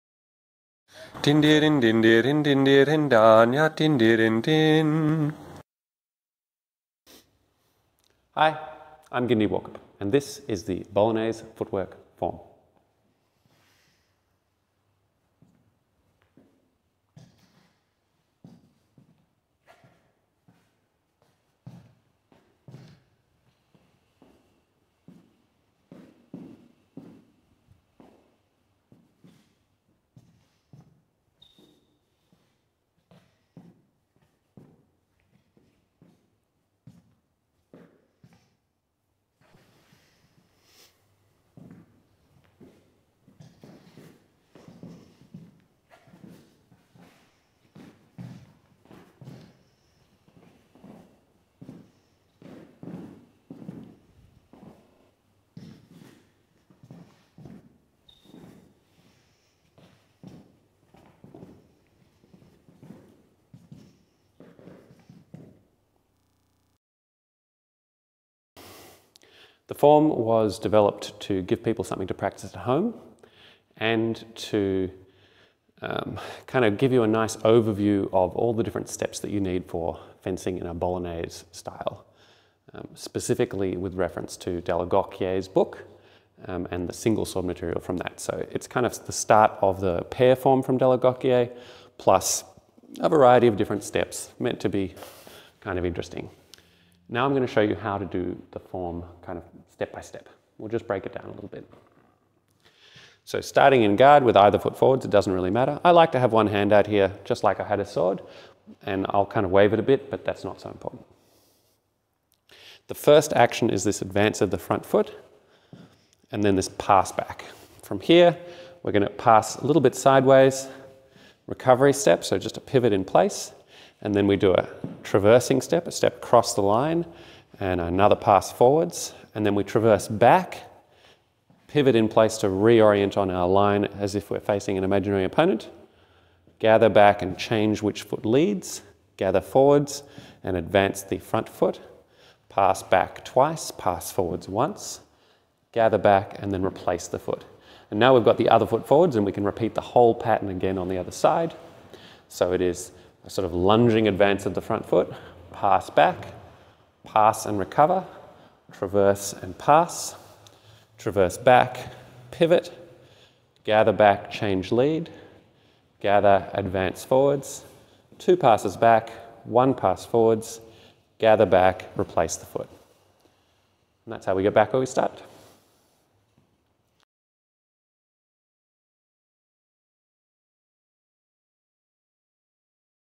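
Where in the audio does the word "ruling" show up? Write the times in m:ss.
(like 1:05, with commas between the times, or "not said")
not said.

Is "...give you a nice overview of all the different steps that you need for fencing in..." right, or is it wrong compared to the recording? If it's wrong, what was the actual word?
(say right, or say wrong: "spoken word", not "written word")
right.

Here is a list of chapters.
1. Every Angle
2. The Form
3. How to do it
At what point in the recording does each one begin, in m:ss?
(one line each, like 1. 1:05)
1. 0:39
2. 0:12
3. 1:08.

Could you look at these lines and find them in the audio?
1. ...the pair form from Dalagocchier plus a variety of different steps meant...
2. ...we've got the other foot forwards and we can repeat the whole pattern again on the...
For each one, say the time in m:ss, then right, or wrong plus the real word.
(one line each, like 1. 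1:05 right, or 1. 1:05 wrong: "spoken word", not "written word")
1. 1:29 right
2. 2:28 right.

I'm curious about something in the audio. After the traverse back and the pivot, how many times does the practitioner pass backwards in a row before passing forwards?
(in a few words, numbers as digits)
2.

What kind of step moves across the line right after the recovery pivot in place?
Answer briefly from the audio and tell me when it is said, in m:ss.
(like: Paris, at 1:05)
Traversing step, at 2:05.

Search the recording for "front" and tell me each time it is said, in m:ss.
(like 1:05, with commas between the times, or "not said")
1:54, 2:21, 2:34.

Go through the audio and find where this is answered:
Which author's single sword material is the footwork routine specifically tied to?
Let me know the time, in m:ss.
1:24.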